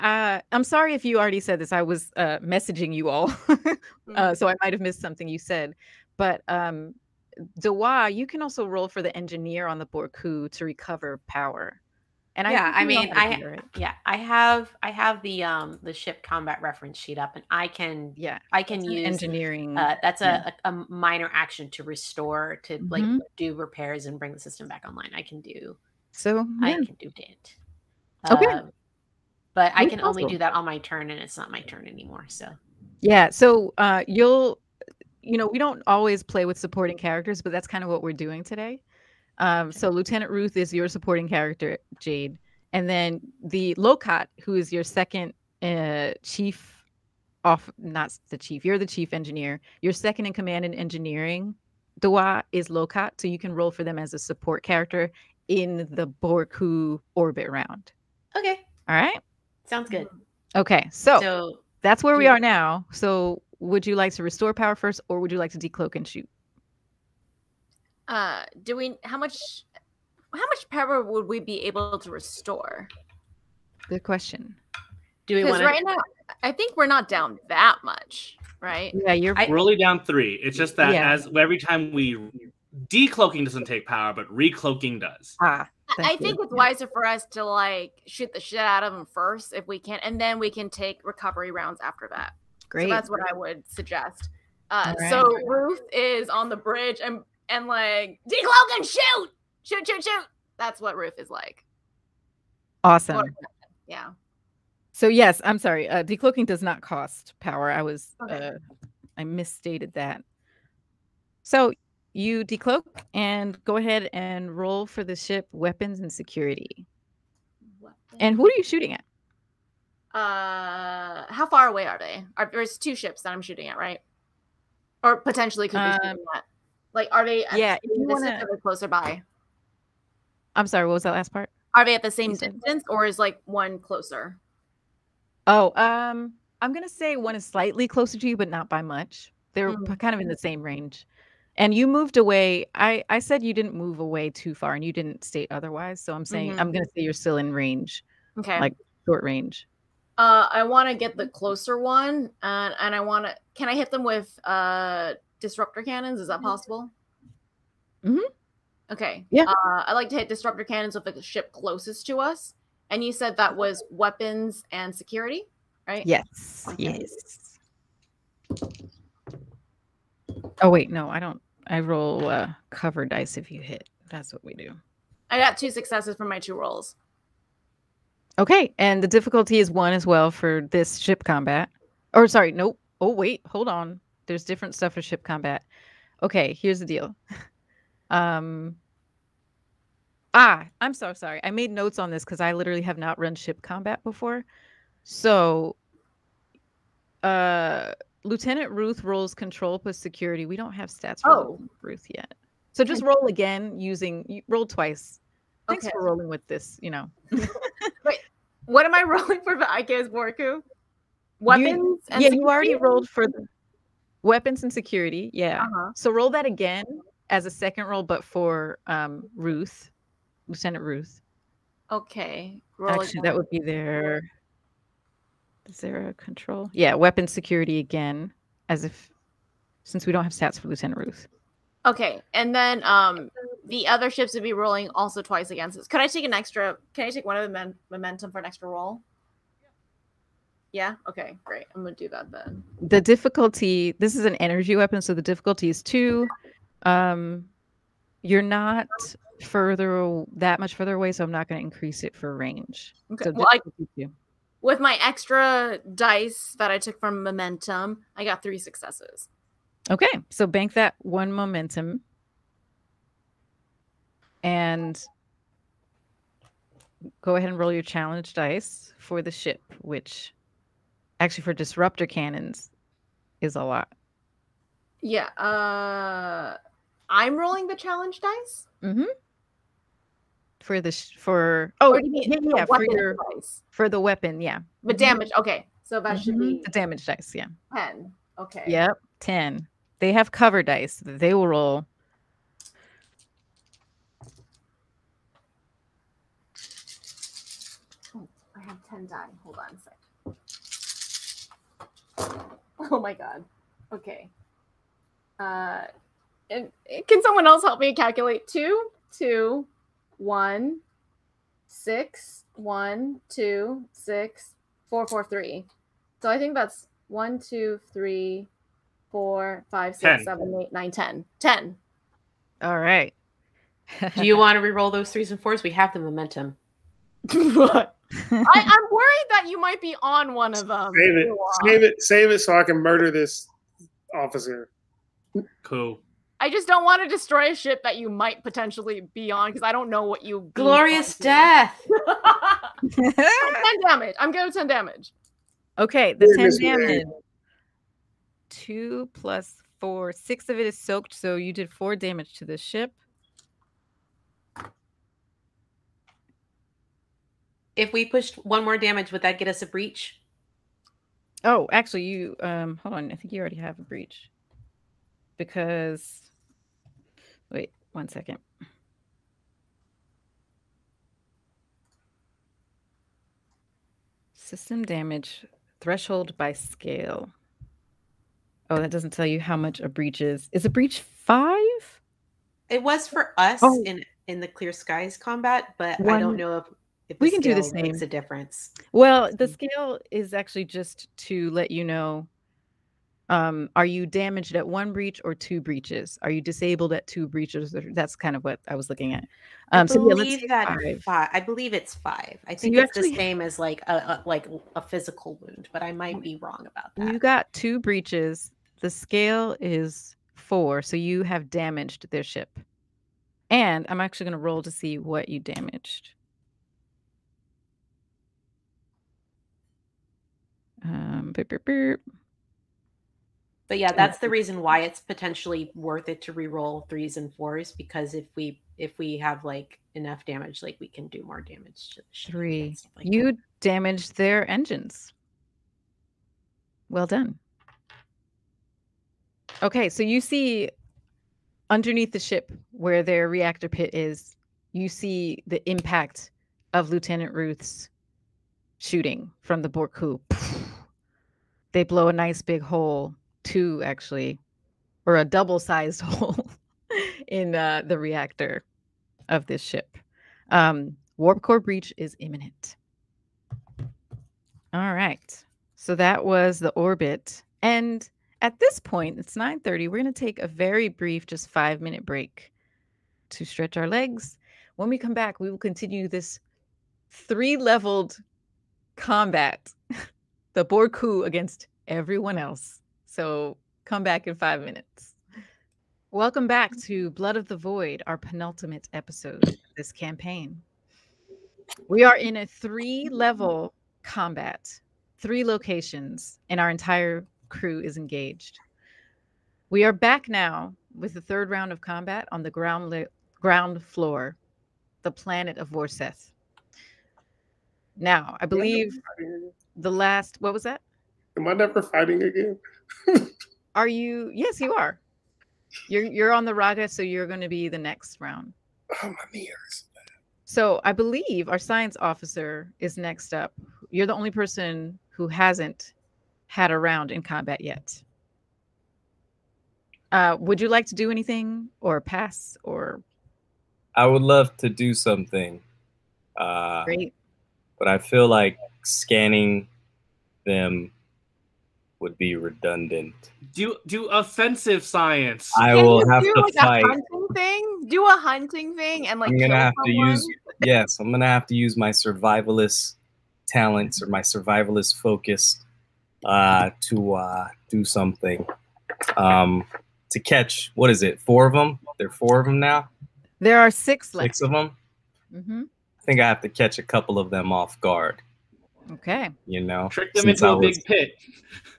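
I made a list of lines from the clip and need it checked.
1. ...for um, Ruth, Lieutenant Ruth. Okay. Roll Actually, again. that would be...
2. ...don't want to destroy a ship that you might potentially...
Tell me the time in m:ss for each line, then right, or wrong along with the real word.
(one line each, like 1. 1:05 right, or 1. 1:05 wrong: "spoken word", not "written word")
1. 3:38 right
2. 5:36 right.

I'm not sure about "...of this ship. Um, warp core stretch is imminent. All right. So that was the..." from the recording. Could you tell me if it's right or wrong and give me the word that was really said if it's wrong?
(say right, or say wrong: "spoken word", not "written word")
wrong: "breach", not "stretch".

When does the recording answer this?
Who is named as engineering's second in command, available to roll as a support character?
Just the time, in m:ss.
0:52.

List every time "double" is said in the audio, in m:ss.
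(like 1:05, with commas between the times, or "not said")
7:35.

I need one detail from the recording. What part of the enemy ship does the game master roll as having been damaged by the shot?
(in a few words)
engines.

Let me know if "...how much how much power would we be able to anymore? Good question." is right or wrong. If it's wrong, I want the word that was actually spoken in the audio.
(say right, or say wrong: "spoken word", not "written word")
wrong: "restore", not "anymore".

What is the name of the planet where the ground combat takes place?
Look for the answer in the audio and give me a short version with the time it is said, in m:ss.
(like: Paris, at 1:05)
Vorseth, at 8:25.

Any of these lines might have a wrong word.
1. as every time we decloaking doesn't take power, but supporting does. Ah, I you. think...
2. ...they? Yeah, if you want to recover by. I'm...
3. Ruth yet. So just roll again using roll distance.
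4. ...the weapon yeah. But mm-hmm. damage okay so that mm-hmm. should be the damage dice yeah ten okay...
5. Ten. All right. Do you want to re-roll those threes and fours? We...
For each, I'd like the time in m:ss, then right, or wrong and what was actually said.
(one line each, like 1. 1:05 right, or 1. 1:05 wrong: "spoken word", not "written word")
1. 1:21 wrong: "recloaking", not "supporting"
2. 2:07 wrong: "closer", not "recover"
3. 3:21 wrong: "twice", not "distance"
4. 4:43 right
5. 5:21 right.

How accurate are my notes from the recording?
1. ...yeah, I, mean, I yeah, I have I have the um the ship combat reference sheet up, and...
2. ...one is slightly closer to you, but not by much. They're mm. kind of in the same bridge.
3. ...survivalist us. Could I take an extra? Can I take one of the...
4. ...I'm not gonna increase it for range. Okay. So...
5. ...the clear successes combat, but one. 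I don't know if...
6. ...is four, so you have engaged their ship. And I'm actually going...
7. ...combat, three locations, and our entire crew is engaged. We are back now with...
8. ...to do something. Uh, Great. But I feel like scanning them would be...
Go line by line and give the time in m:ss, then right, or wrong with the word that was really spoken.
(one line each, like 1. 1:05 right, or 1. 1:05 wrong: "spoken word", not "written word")
1. 0:12 right
2. 2:17 wrong: "range", not "bridge"
3. 3:55 wrong: "against", not "survivalist"
4. 4:11 right
5. 6:24 wrong: "skies", not "successes"
6. 6:49 wrong: "damaged", not "engaged"
7. 8:14 right
8. 8:54 right.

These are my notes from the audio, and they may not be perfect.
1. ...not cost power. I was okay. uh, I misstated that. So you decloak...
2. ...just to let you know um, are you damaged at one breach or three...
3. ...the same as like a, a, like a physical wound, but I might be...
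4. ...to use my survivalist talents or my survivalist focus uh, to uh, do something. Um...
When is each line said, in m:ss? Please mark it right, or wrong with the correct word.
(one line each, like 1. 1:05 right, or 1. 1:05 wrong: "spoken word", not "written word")
1. 1:46 right
2. 6:30 wrong: "two", not "three"
3. 6:43 right
4. 9:11 right.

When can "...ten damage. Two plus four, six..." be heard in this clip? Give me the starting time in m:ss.
5:46.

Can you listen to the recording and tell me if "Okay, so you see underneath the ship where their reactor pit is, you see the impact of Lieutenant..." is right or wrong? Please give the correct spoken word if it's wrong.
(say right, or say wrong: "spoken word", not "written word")
right.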